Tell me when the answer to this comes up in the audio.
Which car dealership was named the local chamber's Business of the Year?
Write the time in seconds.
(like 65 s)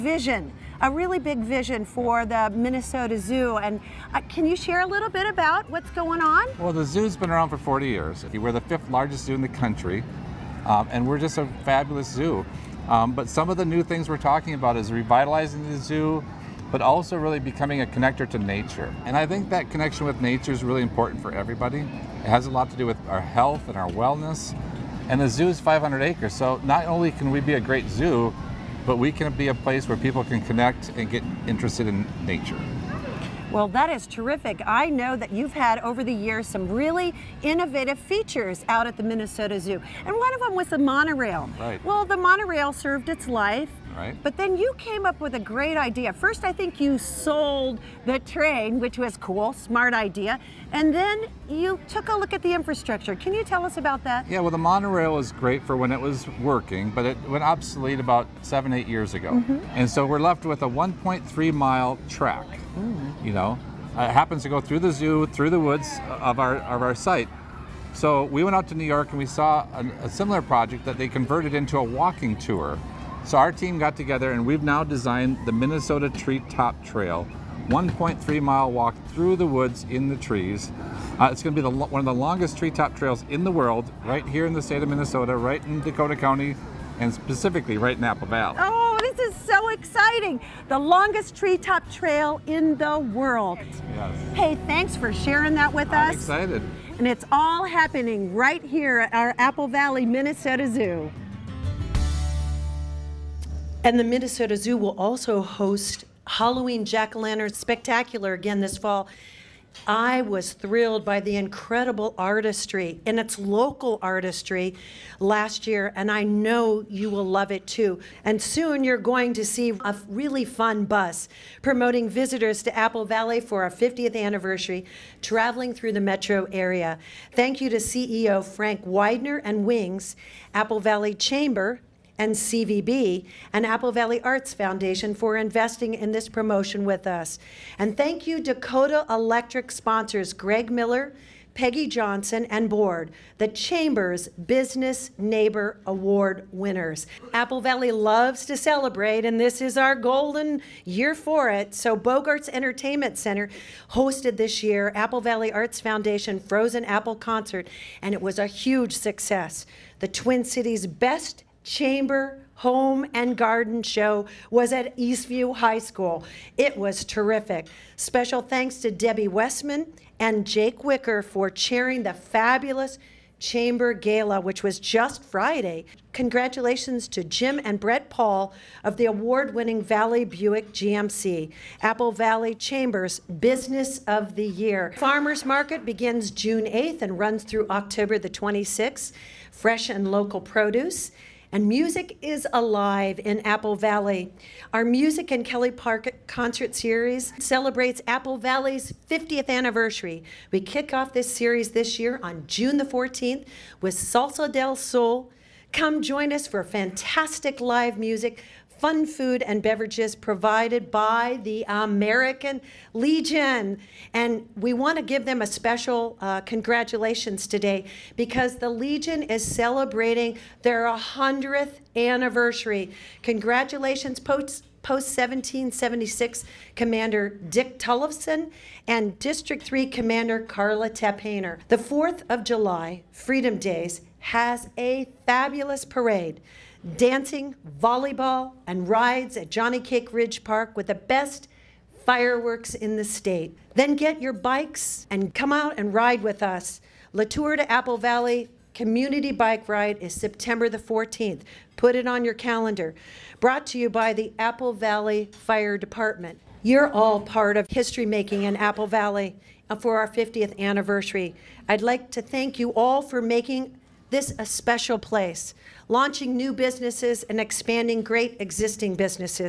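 179 s.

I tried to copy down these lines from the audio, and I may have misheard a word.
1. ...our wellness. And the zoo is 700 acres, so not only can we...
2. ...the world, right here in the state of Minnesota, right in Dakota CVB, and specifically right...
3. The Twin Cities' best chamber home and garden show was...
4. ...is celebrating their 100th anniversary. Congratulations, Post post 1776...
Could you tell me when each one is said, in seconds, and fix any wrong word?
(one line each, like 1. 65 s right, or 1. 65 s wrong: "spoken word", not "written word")
1. 23 s wrong: "500", not "700"
2. 83 s wrong: "County", not "CVB"
3. 160 s right
4. 219 s right.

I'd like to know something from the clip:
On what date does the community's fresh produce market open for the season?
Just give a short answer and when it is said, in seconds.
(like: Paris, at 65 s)
June 8, at 186 s.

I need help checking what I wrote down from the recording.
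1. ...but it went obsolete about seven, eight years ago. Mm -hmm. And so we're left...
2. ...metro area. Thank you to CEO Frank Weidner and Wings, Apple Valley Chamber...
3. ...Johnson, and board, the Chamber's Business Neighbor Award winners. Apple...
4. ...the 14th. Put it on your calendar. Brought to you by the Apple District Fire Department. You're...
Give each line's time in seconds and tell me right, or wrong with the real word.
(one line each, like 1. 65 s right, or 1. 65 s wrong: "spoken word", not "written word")
1. 56 s right
2. 126 s right
3. 141 s right
4. 250 s wrong: "Valley", not "District".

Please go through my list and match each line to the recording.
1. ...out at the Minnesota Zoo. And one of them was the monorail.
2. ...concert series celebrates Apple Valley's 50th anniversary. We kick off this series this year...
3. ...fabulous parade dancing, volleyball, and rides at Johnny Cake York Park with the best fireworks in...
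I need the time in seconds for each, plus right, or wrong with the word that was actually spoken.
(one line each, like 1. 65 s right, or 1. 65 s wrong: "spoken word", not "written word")
1. 38 s right
2. 196 s right
3. 235 s wrong: "Ridge", not "York".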